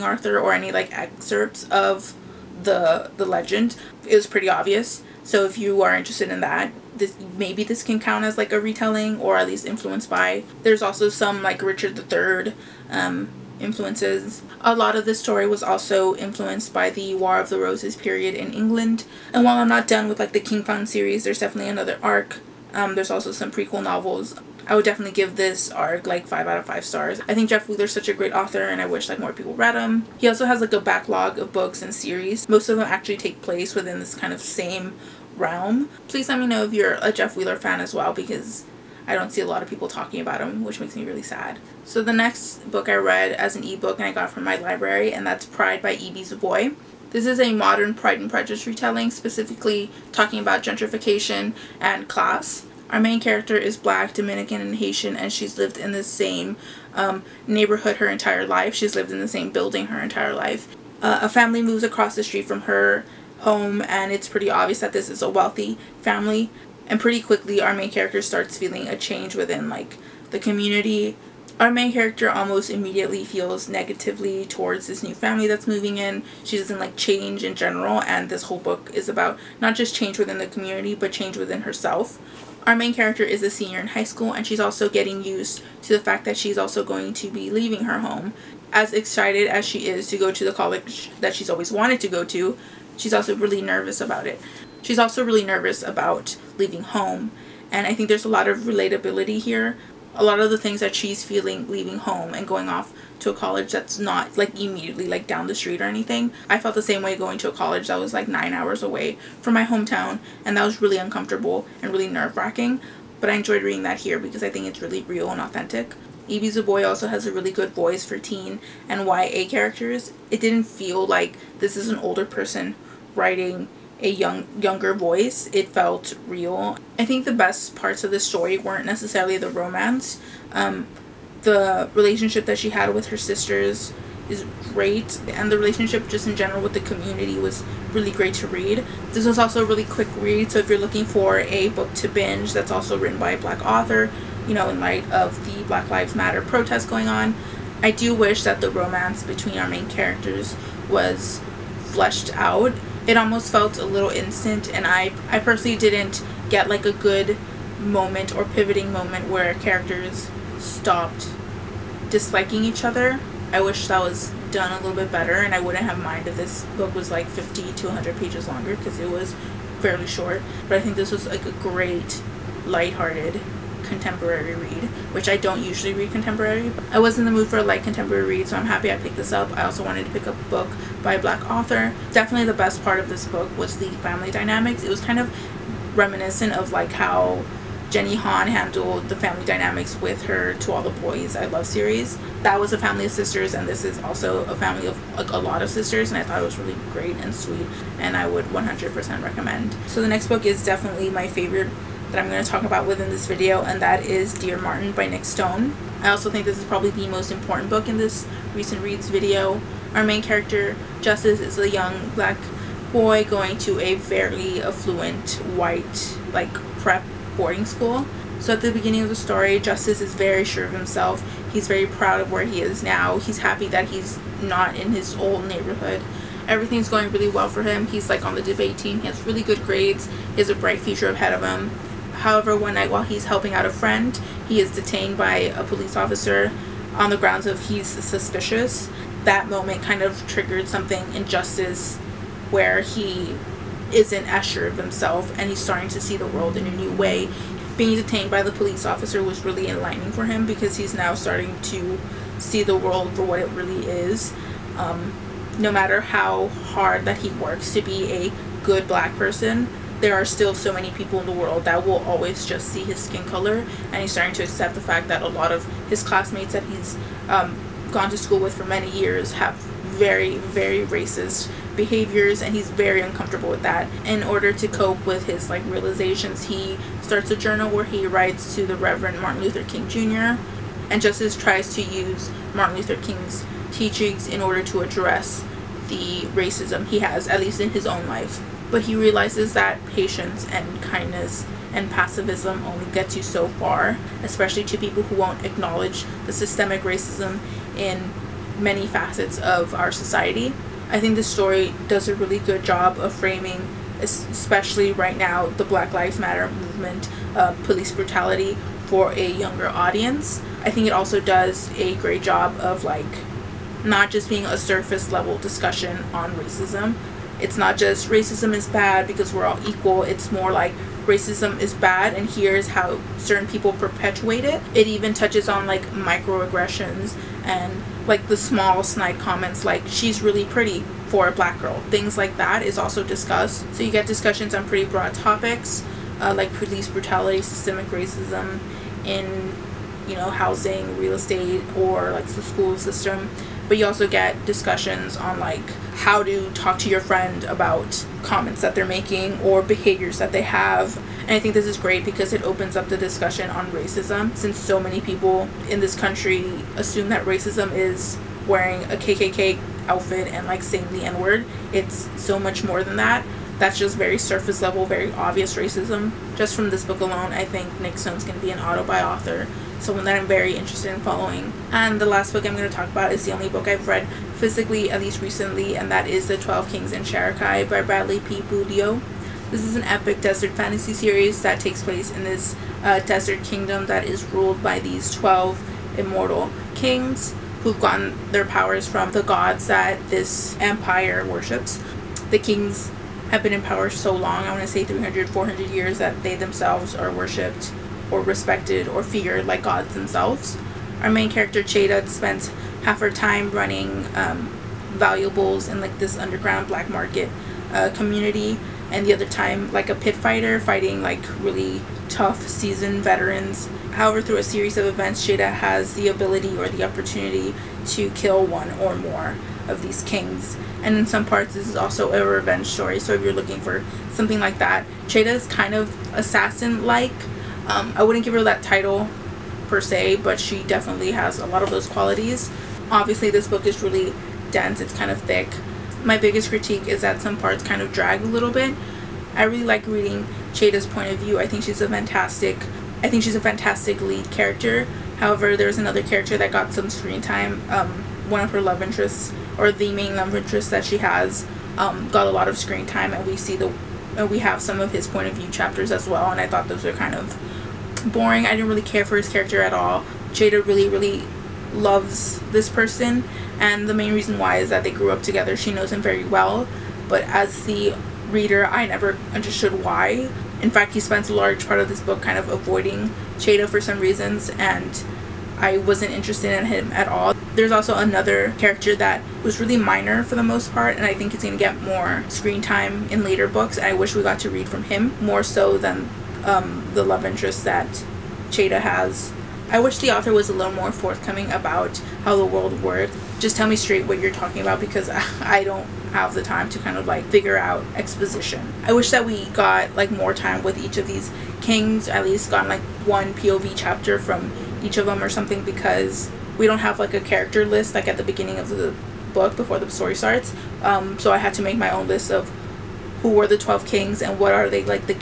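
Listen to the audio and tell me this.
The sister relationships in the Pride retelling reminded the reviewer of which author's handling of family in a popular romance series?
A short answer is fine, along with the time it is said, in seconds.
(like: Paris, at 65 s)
Jenny Han, at 187 s.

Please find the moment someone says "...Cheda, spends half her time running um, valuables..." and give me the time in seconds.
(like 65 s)
401 s.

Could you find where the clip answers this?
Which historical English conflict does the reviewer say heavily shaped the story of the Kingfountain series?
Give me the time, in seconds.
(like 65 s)
17 s.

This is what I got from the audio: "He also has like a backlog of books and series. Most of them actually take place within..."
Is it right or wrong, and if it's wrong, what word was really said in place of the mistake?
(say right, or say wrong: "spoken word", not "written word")
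right.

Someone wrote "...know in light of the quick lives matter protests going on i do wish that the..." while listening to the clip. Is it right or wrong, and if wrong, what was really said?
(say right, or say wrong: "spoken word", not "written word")
wrong: "black", not "quick".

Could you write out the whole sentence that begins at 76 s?
She doesn't like change in general, and this whole book is about not just change within the community, but change within herself.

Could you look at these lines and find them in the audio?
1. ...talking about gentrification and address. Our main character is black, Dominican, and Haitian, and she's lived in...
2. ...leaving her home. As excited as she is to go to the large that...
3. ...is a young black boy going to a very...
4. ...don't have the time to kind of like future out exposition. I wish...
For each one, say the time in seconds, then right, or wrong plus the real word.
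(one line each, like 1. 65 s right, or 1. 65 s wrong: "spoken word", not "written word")
1. 50 s wrong: "class", not "address"
2. 87 s wrong: "college", not "large"
3. 211 s right
4. 495 s wrong: "figure", not "future".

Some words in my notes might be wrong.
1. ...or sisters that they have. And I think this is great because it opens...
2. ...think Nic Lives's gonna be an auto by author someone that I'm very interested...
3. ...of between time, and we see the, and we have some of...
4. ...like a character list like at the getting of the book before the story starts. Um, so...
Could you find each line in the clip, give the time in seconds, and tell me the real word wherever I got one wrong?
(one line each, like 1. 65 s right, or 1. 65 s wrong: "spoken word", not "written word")
1. 349 s wrong: "behaviors", not "sisters"
2. 367 s wrong: "Stone", not "Lives"
3. 452 s wrong: "screen", not "between"
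4. 506 s wrong: "beginning", not "getting".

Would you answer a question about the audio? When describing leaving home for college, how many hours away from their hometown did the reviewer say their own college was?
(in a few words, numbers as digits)
9.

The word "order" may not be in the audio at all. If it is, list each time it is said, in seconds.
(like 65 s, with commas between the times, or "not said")
274 s, 284 s.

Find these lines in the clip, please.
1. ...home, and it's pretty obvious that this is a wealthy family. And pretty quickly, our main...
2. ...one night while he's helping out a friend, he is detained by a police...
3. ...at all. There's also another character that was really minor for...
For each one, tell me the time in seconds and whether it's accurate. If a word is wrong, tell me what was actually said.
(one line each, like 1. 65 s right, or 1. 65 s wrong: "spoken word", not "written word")
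1. 63 s right
2. 232 s right
3. 476 s right.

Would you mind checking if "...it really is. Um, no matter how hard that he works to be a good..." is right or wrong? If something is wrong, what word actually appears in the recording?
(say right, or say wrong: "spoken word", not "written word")
right.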